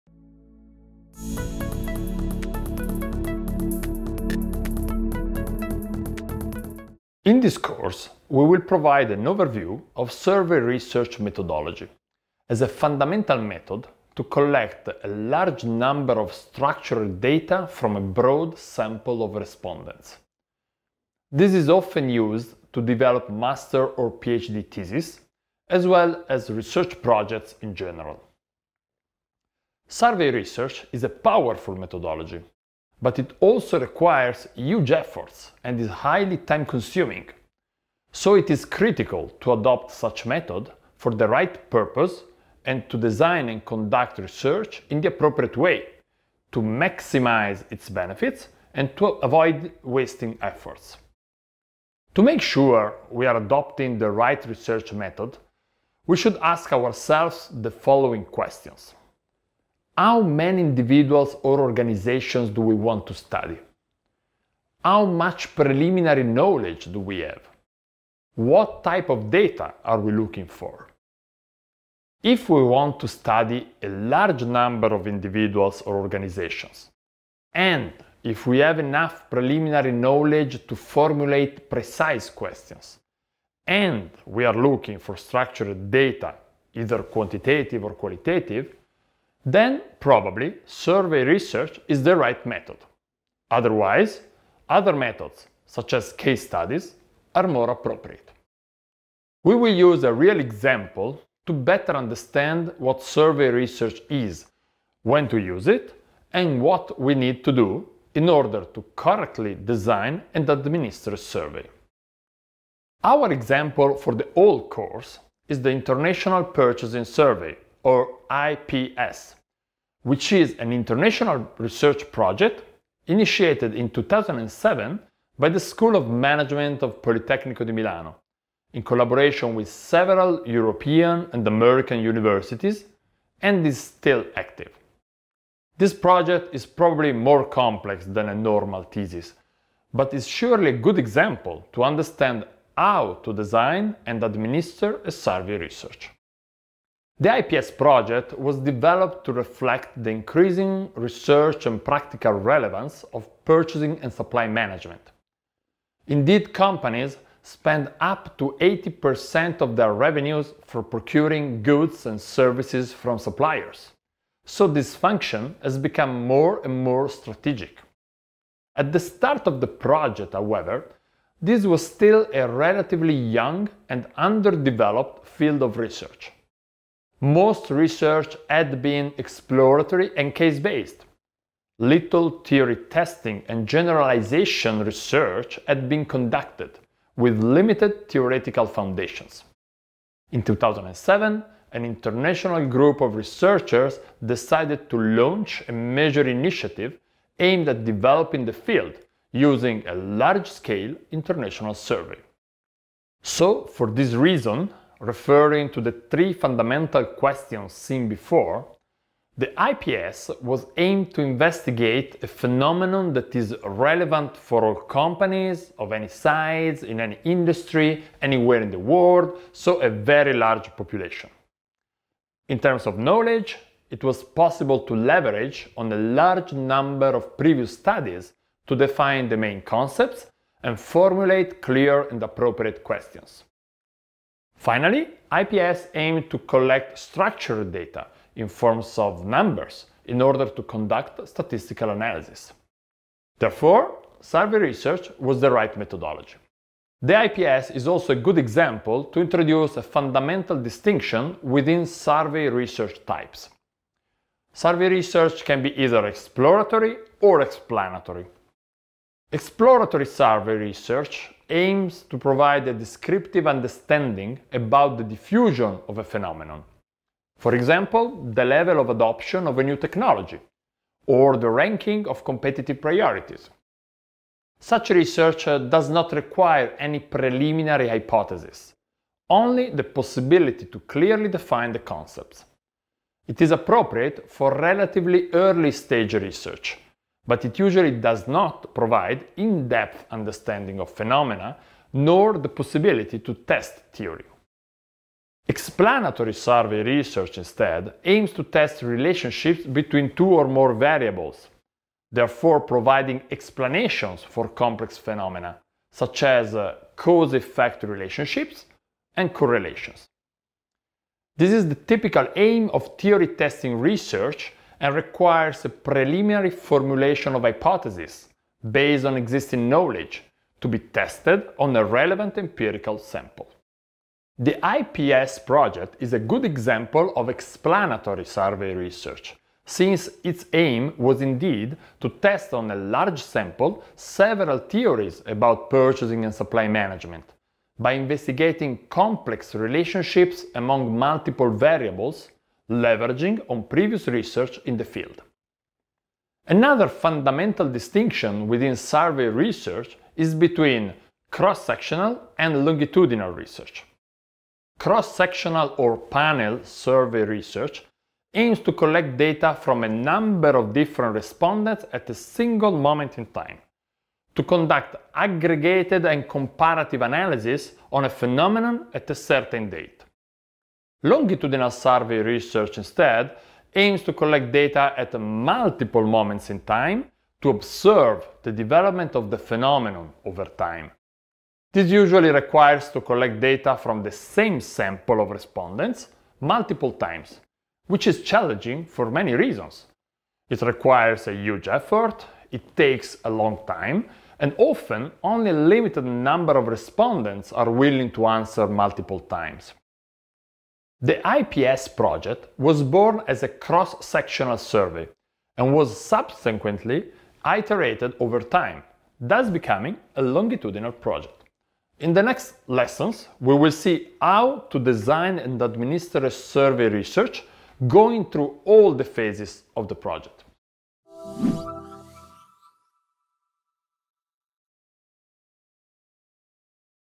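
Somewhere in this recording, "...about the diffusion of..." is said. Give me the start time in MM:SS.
04:24.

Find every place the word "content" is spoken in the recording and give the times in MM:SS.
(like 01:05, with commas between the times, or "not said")
not said.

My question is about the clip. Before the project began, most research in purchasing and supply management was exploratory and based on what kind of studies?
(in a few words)
case-based.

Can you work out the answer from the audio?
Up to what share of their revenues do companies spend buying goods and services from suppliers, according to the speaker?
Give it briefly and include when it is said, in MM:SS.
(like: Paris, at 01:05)
80%, at 02:38.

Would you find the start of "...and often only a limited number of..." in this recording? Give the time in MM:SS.
06:34.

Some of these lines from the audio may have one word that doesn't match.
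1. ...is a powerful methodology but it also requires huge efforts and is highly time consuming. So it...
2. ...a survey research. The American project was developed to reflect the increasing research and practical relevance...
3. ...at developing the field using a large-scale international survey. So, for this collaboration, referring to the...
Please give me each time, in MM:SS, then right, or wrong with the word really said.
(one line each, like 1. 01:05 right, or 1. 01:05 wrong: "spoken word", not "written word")
1. 00:30 right
2. 02:25 wrong: "IPS", not "American"
3. 03:17 wrong: "reason", not "collaboration".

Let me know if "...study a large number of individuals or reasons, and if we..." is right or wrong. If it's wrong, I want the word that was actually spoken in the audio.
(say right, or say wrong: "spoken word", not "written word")
wrong: "organizations", not "reasons".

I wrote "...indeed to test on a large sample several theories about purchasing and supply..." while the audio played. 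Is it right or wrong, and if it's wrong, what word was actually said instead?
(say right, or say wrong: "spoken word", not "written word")
right.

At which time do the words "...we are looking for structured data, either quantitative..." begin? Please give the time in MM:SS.
01:24.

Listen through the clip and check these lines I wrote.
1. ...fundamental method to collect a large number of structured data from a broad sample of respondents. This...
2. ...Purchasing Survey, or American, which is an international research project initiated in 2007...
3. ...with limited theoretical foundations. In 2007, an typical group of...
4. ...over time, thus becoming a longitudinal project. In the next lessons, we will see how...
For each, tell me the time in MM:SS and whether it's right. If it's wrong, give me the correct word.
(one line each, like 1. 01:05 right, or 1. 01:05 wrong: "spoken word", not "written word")
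1. 00:12 right
2. 01:56 wrong: "IPS", not "American"
3. 03:07 wrong: "international", not "typical"
4. 06:48 right.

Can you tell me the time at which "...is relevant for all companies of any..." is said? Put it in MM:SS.
03:33.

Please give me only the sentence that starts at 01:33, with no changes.
Otherwise, other methods, such as case studies, are more appropriate.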